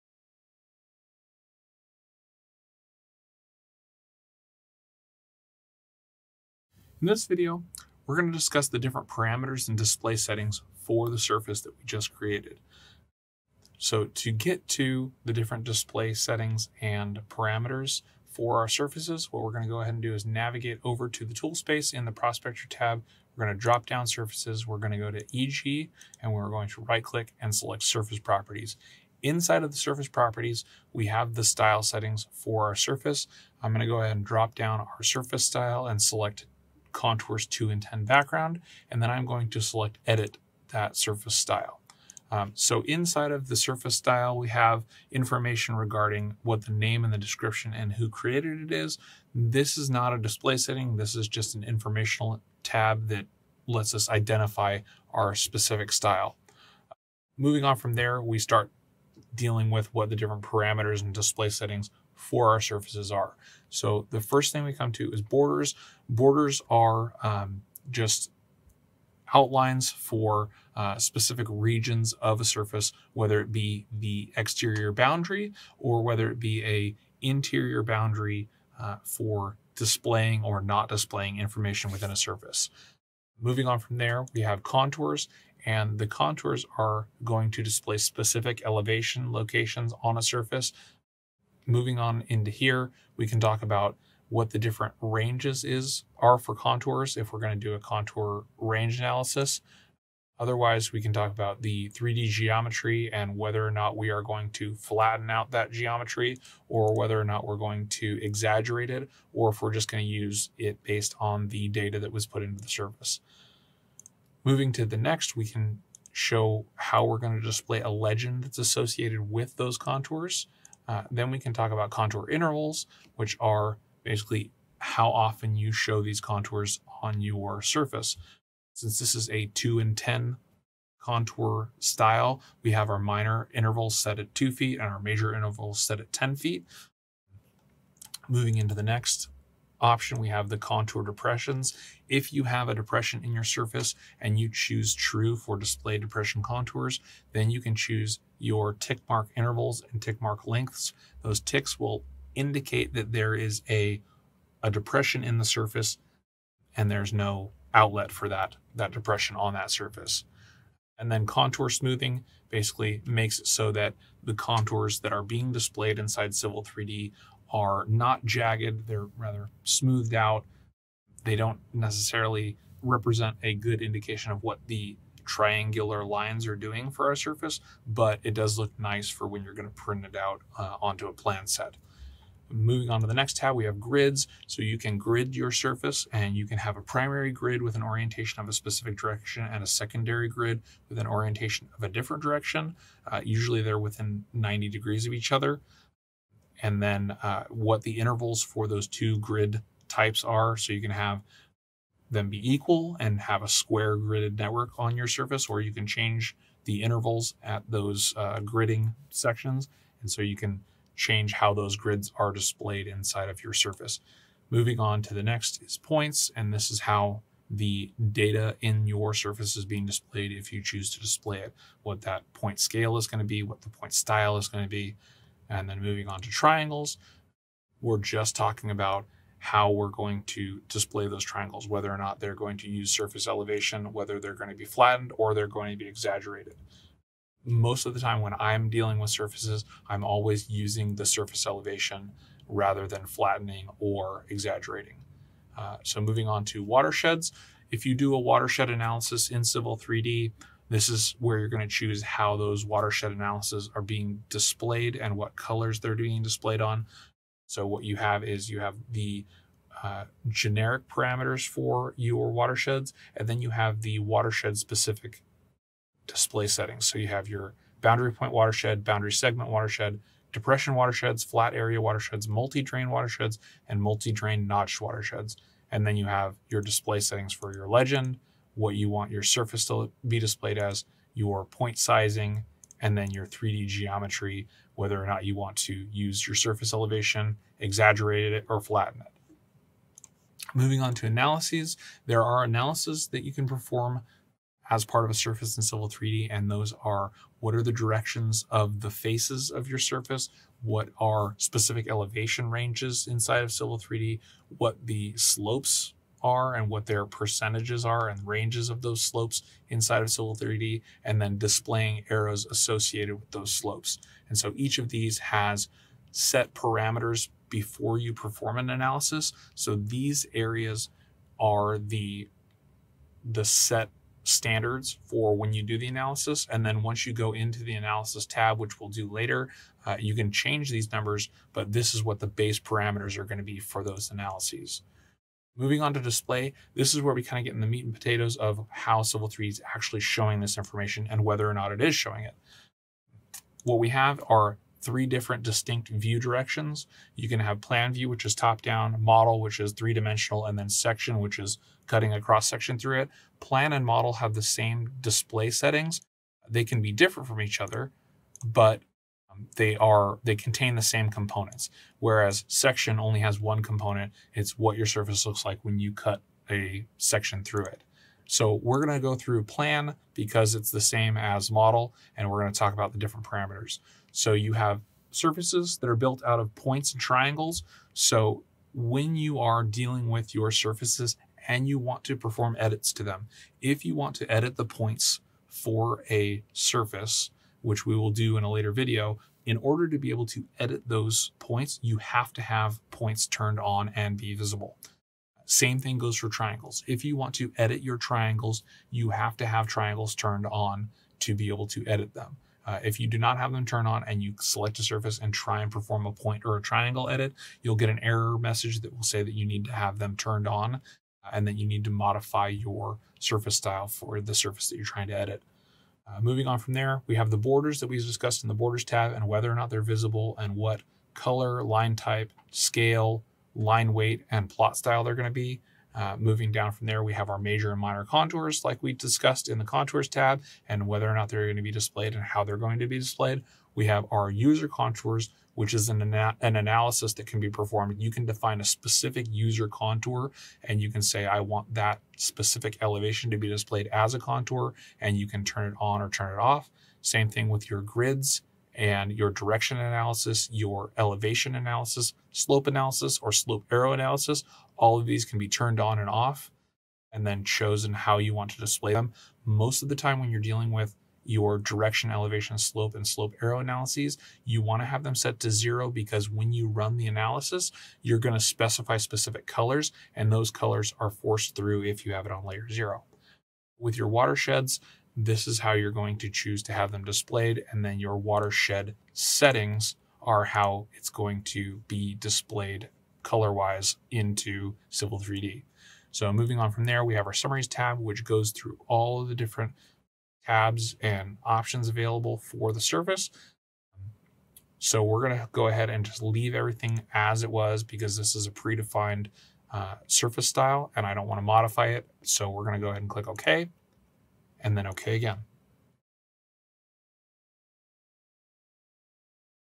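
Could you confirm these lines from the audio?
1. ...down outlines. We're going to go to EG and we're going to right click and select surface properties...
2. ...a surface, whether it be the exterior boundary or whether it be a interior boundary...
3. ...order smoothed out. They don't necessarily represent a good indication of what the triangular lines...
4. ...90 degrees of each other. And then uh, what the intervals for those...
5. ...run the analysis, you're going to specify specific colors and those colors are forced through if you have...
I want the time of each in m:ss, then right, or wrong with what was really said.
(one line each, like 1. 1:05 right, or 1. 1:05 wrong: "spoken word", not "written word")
1. 0:23 wrong: "surfaces", not "outlines"
2. 1:12 right
3. 2:49 wrong: "rather", not "order"
4. 3:14 right
5. 7:46 right.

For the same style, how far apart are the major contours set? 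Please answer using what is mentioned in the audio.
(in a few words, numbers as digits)
10 feet.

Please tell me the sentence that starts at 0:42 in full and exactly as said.
Um, so inside of the surface style, we have information regarding what the name and the description and who created it is.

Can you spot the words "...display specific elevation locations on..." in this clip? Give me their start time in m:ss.
1:27.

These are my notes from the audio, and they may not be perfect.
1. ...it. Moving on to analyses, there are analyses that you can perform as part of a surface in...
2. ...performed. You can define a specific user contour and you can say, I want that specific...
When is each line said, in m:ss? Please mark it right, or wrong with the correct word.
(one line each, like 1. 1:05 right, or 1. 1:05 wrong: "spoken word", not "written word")
1. 4:49 right
2. 7:17 right.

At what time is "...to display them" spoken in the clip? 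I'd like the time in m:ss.
7:38.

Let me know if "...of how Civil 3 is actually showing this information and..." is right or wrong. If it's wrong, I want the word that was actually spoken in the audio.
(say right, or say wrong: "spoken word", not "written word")
right.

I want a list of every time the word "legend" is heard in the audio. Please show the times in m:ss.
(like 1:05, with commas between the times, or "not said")
1:57, 4:37.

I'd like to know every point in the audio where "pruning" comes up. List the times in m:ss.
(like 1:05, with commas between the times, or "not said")
not said.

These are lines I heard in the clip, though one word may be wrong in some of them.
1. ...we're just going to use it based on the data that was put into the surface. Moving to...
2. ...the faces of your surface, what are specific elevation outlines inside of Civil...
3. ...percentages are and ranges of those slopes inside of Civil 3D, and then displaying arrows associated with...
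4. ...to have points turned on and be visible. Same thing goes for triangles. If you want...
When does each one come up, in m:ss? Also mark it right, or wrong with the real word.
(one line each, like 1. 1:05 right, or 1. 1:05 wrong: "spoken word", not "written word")
1. 1:49 right
2. 4:58 wrong: "ranges", not "outlines"
3. 5:07 right
4. 6:32 right.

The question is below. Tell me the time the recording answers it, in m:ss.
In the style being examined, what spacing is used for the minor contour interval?
2:14.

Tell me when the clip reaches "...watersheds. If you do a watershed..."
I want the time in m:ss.
4:06.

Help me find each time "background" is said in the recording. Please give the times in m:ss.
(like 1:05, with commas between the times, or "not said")
0:38.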